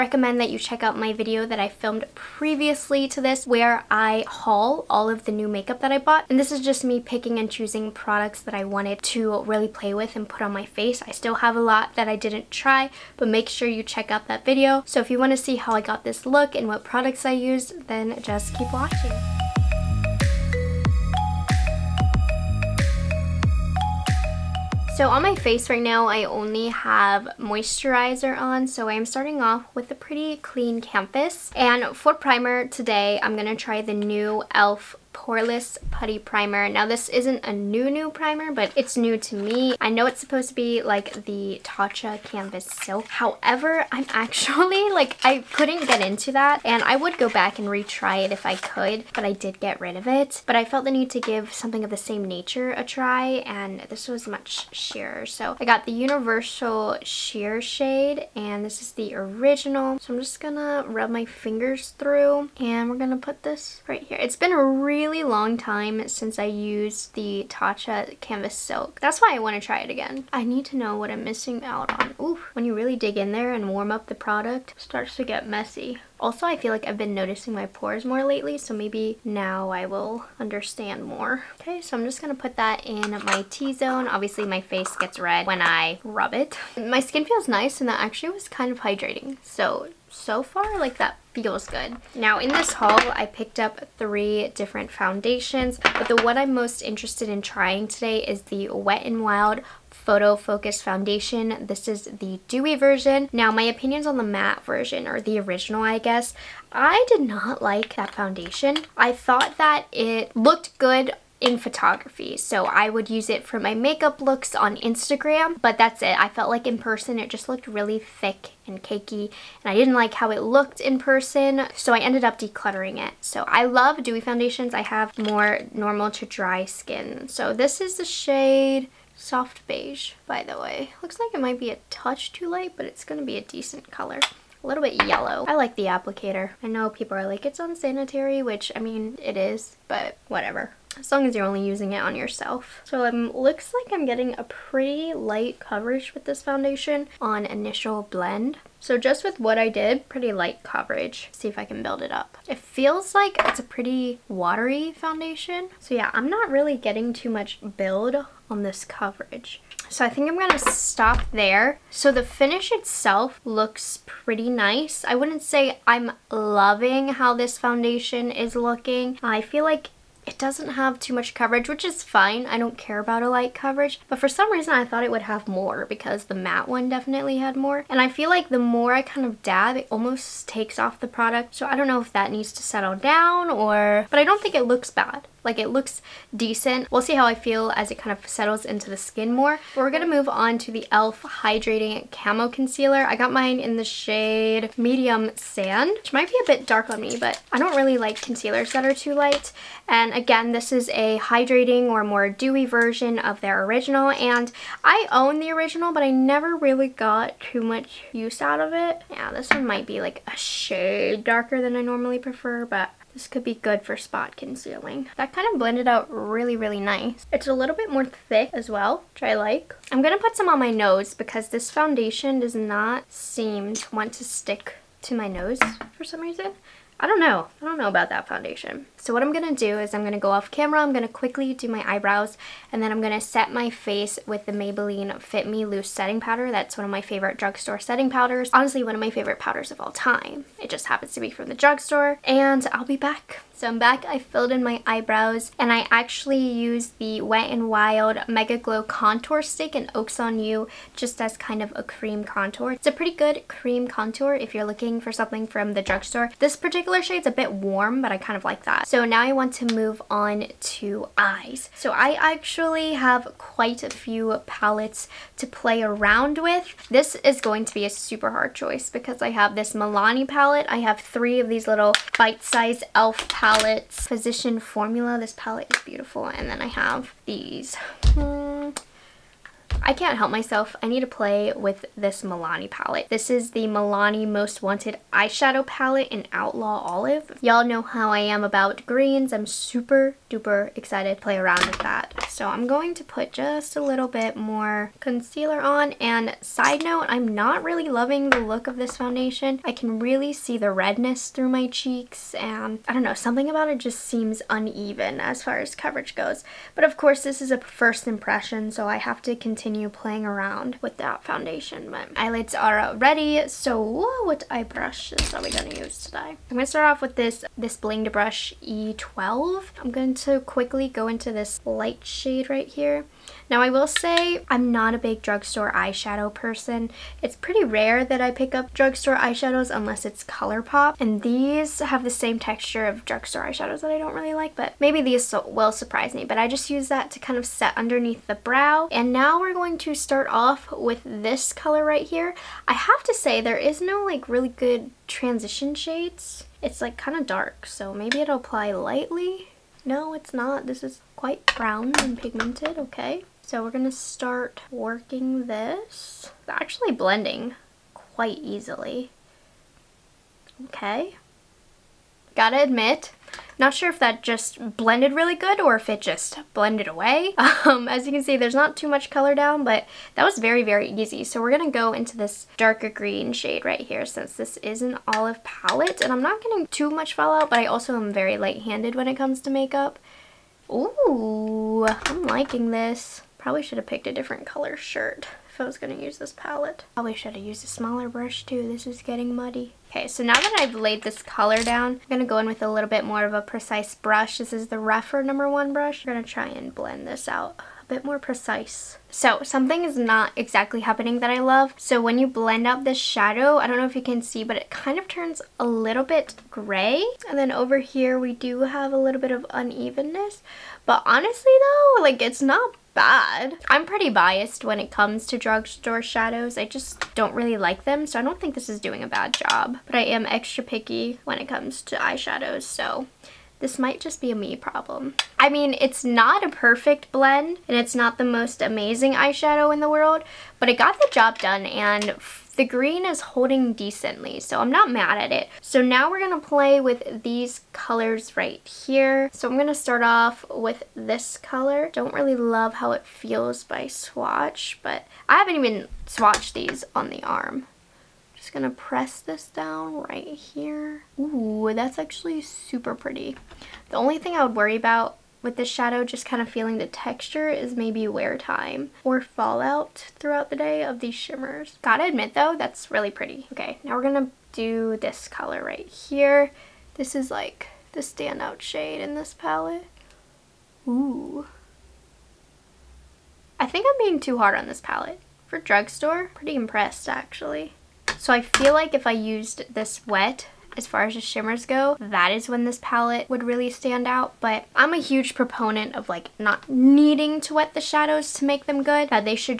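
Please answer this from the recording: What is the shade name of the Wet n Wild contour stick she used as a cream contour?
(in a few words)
Oaks on You.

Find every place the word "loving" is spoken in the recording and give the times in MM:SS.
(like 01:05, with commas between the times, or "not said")
02:46, 04:57.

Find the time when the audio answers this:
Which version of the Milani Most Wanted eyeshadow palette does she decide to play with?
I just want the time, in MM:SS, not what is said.
04:46.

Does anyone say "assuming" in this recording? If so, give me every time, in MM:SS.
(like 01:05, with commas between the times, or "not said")
not said.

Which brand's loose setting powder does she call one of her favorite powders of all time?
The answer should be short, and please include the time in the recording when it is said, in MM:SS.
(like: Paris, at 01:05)
Maybelline, at 03:54.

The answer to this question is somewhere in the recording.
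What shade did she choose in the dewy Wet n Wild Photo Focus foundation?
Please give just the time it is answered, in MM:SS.
02:09.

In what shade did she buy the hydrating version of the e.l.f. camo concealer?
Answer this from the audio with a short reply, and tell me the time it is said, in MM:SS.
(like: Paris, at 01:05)
Medium Sand, at 03:14.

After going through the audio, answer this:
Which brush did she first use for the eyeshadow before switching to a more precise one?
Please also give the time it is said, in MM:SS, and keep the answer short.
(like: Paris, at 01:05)
Blinged Brush E12, at 05:17.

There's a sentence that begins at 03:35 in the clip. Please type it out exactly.
That kind of blended out really, really nice.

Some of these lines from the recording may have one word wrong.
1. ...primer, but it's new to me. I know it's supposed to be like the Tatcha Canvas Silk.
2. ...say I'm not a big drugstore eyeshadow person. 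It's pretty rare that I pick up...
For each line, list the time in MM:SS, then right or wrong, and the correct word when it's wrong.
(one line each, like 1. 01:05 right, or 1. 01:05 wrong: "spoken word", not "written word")
1. 00:38 right
2. 05:23 right.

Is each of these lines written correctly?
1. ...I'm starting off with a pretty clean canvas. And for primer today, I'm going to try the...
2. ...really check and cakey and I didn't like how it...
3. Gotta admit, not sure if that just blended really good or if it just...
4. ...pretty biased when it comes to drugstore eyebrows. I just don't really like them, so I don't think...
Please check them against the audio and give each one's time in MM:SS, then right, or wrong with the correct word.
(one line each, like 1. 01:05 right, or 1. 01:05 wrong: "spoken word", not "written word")
1. 00:28 right
2. 01:57 wrong: "thick", not "check"
3. 06:02 right
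4. 06:53 wrong: "shadows", not "eyebrows".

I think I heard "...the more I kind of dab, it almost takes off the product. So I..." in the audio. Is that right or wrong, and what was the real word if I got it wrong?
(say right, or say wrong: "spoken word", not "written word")
right.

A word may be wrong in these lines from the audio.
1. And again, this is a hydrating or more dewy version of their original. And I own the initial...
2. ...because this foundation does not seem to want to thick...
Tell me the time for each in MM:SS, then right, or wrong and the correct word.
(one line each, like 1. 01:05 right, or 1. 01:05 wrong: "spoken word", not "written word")
1. 03:19 wrong: "original", not "initial"
2. 03:41 wrong: "stick", not "thick".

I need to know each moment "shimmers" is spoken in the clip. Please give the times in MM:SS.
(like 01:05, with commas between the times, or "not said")
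07:41, 08:01.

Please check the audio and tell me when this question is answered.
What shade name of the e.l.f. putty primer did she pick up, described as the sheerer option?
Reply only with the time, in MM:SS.
00:55.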